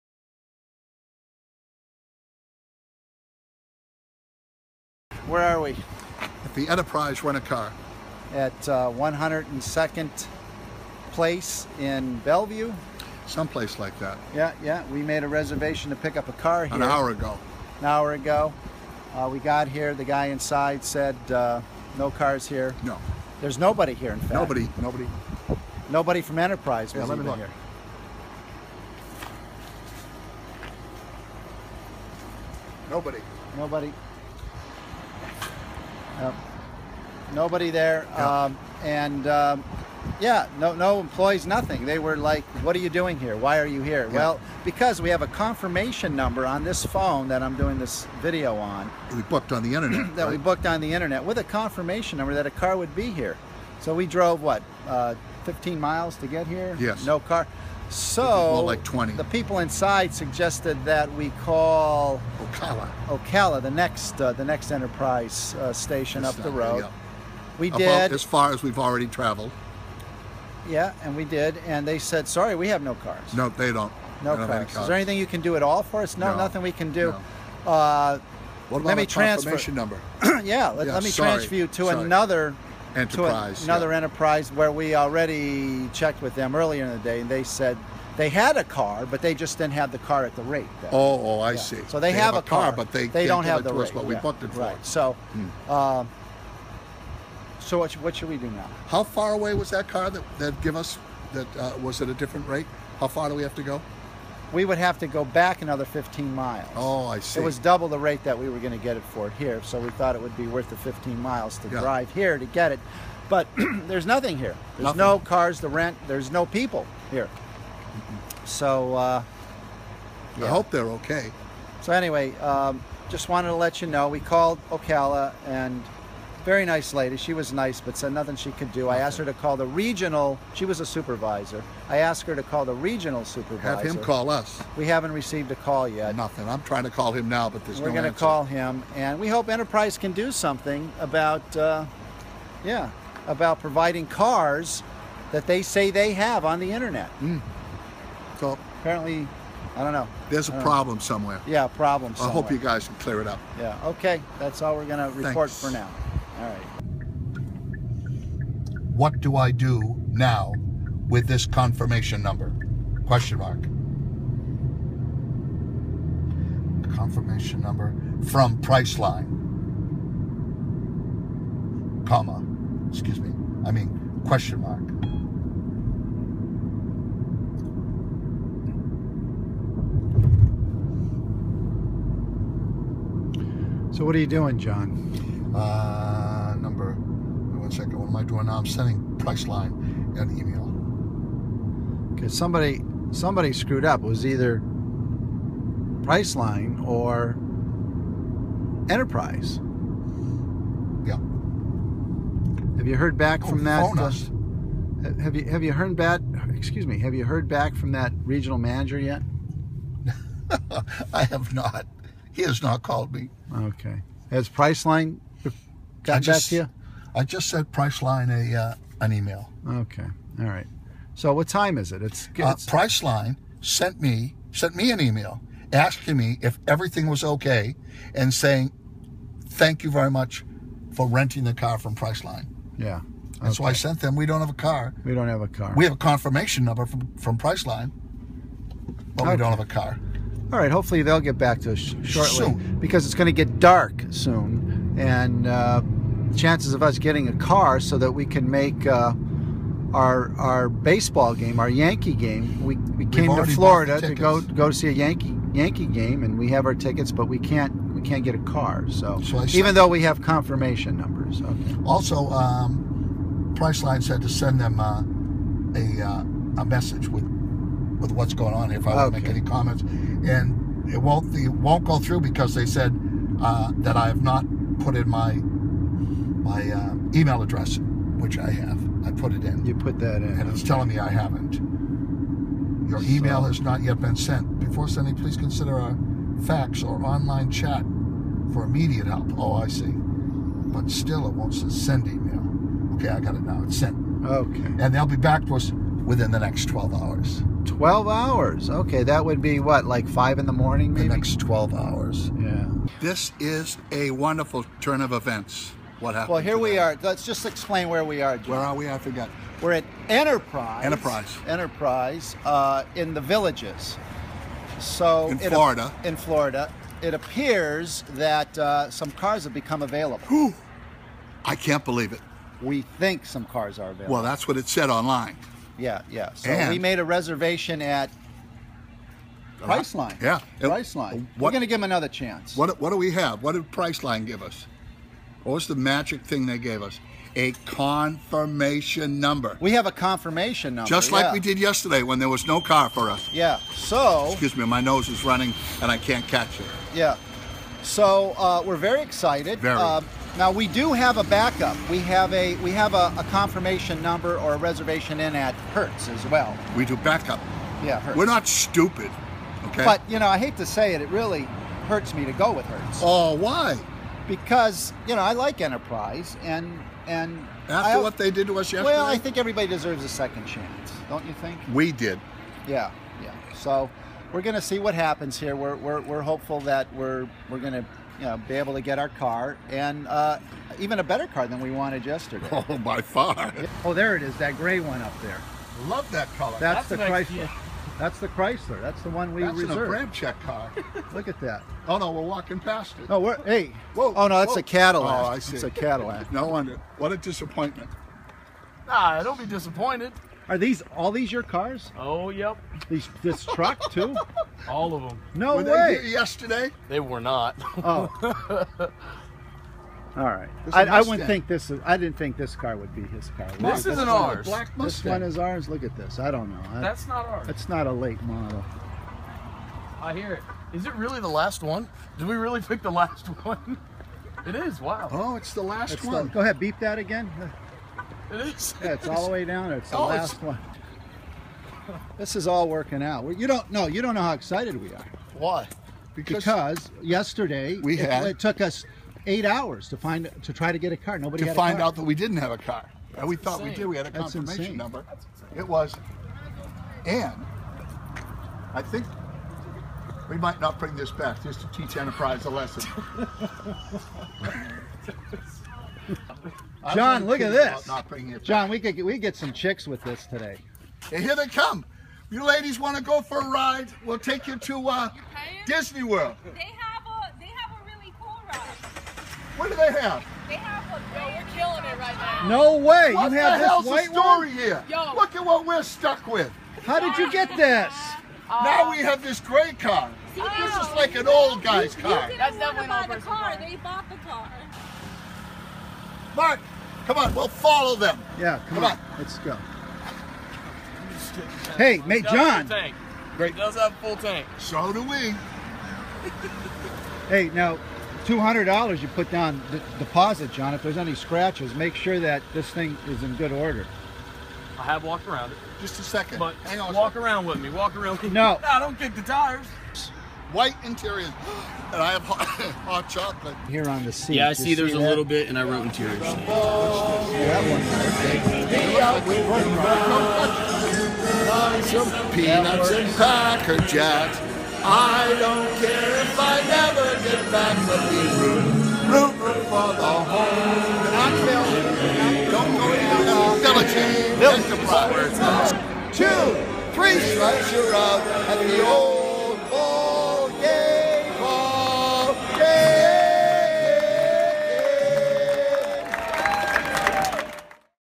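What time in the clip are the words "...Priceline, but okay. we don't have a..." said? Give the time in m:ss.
3:57.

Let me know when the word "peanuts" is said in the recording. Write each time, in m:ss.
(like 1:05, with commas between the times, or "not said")
8:42.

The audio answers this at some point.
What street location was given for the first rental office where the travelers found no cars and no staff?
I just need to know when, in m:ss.
0:08.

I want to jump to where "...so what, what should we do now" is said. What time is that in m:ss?
1:37.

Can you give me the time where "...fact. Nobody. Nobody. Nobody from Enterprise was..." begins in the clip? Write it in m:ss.
0:24.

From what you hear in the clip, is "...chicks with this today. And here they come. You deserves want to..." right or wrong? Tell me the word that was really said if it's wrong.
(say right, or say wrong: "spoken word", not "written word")
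wrong: "ladies", not "deserves".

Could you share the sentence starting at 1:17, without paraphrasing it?
Uh, what about let me transfer.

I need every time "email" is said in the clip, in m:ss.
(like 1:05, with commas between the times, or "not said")
3:10, 3:39, 3:44, 4:37, 4:43, 4:52.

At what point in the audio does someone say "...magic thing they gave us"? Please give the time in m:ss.
5:35.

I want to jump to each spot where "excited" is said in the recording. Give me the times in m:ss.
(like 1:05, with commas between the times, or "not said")
5:49, 7:14.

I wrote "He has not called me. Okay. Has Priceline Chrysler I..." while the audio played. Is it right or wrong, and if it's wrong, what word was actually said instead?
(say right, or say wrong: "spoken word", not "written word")
wrong: "Got", not "Chrysler".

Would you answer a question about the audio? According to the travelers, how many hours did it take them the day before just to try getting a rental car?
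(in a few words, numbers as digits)
8.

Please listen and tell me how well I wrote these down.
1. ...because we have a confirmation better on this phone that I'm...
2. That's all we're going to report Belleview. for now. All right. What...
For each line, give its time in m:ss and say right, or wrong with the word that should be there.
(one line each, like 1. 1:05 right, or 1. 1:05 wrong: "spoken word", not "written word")
1. 0:44 wrong: "number", not "better"
2. 2:34 wrong: "Thanks", not "Belleview".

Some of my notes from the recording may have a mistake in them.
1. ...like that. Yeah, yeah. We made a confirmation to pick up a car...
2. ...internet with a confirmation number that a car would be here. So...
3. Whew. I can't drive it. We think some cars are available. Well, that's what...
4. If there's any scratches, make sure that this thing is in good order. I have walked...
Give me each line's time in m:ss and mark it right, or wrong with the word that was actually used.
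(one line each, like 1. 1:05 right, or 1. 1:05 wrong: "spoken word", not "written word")
1. 0:13 wrong: "reservation", not "confirmation"
2. 0:50 right
3. 5:20 wrong: "believe", not "drive"
4. 8:20 right.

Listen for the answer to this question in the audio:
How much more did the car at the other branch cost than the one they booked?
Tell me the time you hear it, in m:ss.
1:47.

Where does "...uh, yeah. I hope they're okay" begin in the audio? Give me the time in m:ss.
1:58.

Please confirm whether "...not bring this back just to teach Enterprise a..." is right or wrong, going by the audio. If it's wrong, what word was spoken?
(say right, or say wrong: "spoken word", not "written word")
right.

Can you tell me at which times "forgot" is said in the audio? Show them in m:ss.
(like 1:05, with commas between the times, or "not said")
5:08.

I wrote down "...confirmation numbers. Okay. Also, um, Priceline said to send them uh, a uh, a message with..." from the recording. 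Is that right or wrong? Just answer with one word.
right.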